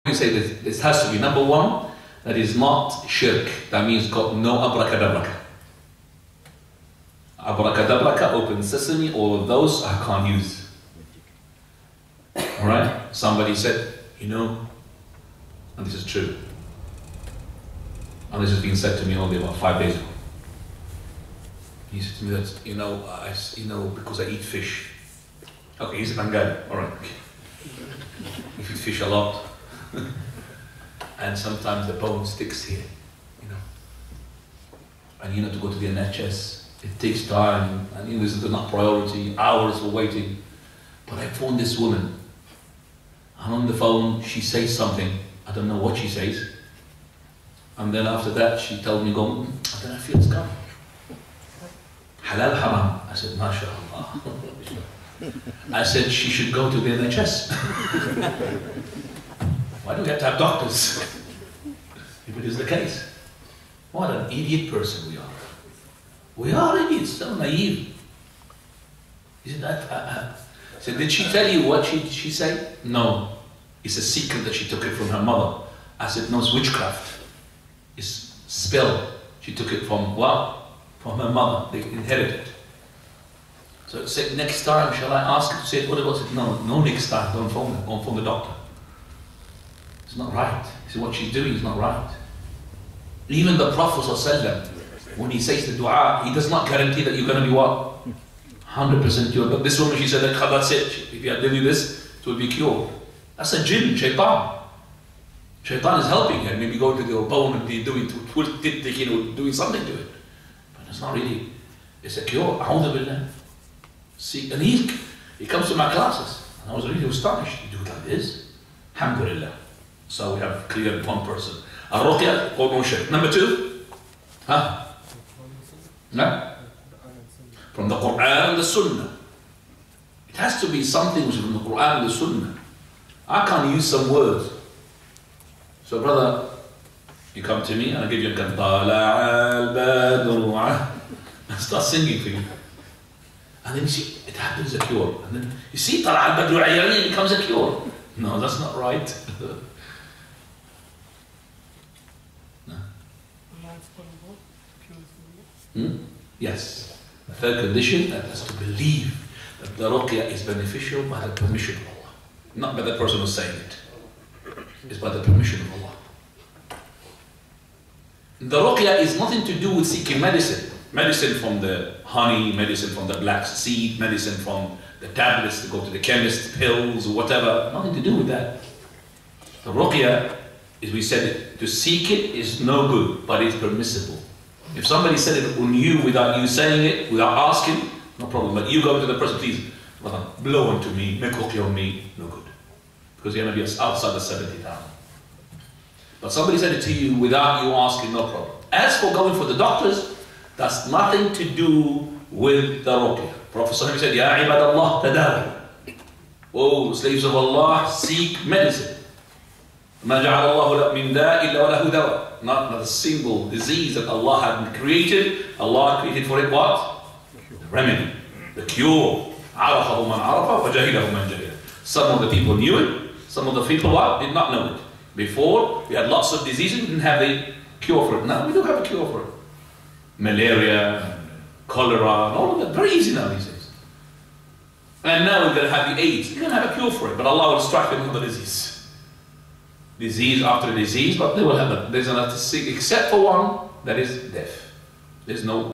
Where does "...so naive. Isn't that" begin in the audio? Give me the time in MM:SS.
01:07.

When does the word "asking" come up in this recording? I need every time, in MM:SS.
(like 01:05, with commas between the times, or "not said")
03:07, 03:17.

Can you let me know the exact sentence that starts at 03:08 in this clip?
But you go to the person, please, blow onto me, make on me, no good.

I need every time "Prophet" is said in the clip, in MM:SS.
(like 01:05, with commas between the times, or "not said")
01:33, 03:23.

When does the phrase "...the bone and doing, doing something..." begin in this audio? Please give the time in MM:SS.
01:47.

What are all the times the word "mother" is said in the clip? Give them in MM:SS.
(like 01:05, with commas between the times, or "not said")
01:15, 01:21.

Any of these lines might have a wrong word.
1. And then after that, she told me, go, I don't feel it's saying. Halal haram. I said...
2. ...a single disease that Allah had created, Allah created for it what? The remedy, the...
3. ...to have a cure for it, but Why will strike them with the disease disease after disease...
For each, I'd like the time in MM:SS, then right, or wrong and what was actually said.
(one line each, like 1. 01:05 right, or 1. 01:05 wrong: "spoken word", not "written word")
1. 00:47 wrong: "coming", not "saying"
2. 03:32 right
3. 03:56 wrong: "Allah", not "Why".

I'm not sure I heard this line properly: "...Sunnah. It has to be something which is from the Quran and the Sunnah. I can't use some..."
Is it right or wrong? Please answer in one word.
right.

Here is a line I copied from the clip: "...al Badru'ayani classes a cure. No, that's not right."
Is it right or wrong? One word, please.
wrong.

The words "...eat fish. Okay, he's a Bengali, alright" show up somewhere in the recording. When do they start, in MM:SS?
00:24.